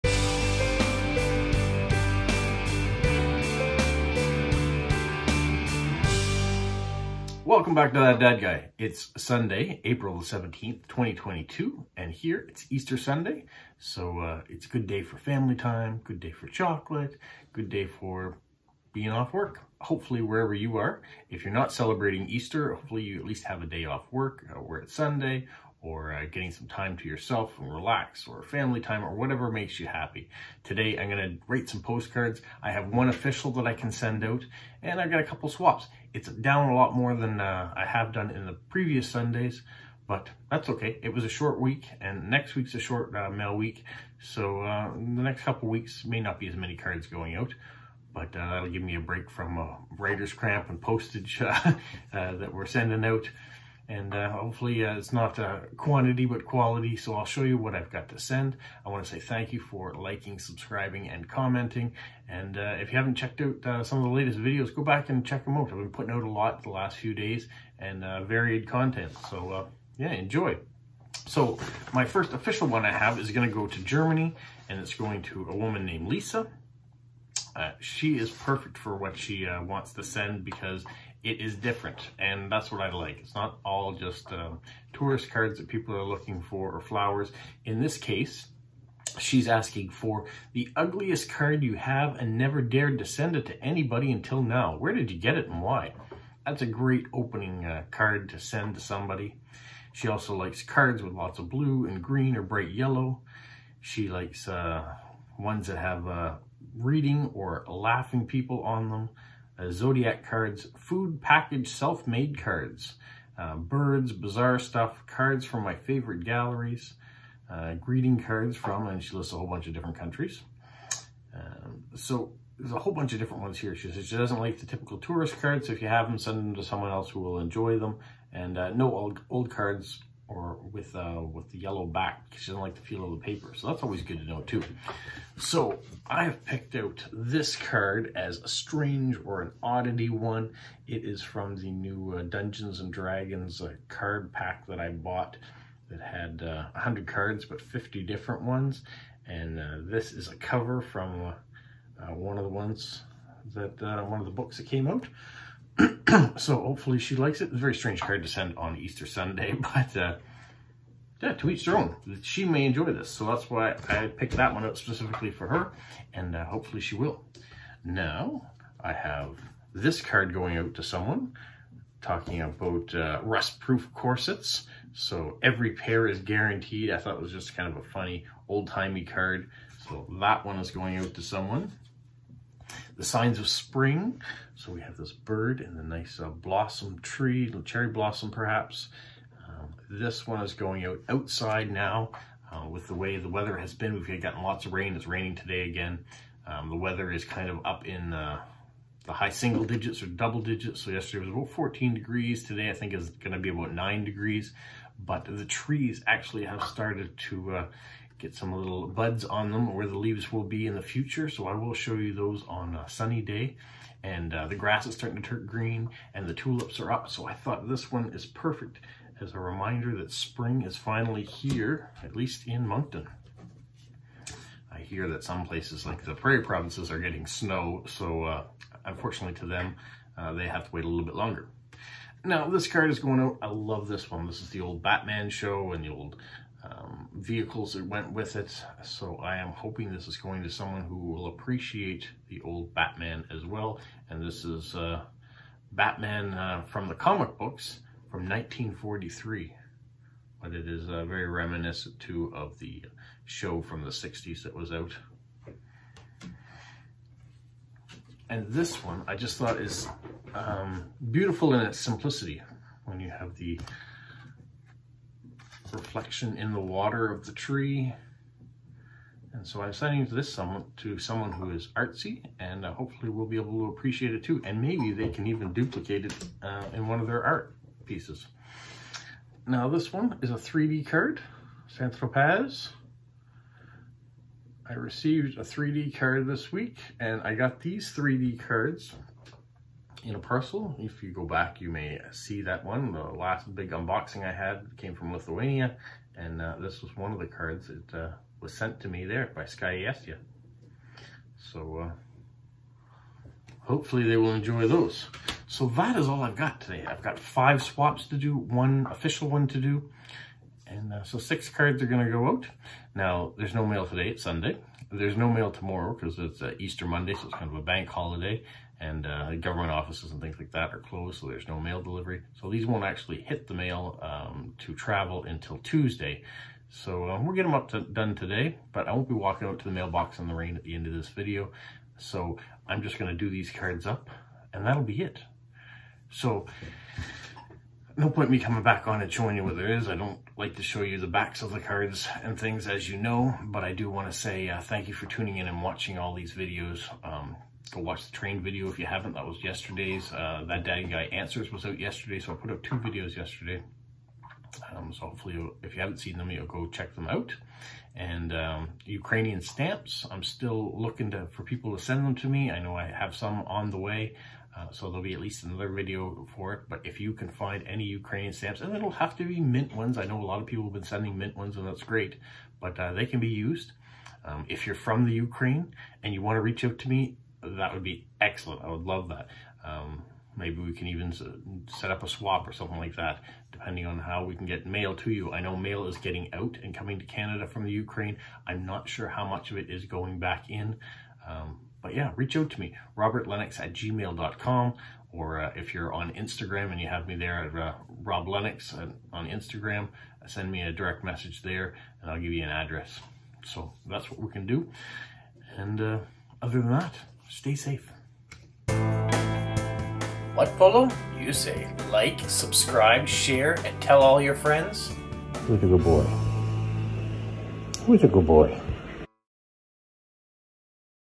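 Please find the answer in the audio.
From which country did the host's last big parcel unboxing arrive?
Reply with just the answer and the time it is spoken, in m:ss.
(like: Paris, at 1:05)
Lithuania, at 4:55.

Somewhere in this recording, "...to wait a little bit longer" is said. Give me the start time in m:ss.
3:50.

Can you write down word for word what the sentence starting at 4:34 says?
And maybe they can even duplicate it uh, in one of their art pieces.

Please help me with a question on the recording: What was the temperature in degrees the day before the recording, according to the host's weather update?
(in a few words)
14.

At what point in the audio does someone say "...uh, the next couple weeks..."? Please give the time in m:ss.
0:44.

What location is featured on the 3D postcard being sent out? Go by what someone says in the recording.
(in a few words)
Saint-Tropez.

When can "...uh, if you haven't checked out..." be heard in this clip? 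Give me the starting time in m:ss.
1:02.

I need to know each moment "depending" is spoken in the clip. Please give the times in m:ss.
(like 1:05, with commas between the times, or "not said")
6:23.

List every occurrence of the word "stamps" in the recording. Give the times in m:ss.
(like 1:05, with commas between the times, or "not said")
5:59, 6:08.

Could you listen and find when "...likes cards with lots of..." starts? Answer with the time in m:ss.
1:40.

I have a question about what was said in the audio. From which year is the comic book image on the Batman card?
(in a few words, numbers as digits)
1943.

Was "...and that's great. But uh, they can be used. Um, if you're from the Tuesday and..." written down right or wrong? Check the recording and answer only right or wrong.
wrong.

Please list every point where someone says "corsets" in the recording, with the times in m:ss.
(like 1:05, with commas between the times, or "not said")
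2:53.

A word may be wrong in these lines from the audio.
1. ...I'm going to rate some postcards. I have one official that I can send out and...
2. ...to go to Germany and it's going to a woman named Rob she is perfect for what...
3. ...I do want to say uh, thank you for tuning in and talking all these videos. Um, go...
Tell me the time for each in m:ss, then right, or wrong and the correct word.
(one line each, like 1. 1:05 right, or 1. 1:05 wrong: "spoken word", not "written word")
1. 0:30 right
2. 1:13 wrong: "Lisa", not "Rob"
3. 5:43 wrong: "watching", not "talking".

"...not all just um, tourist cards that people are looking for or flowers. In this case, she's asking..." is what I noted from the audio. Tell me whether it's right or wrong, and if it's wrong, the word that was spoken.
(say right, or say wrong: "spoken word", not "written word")
right.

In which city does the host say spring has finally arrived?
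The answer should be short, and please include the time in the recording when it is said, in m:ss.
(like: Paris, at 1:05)
Moncton, at 3:42.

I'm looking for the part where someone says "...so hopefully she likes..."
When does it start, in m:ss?
2:36.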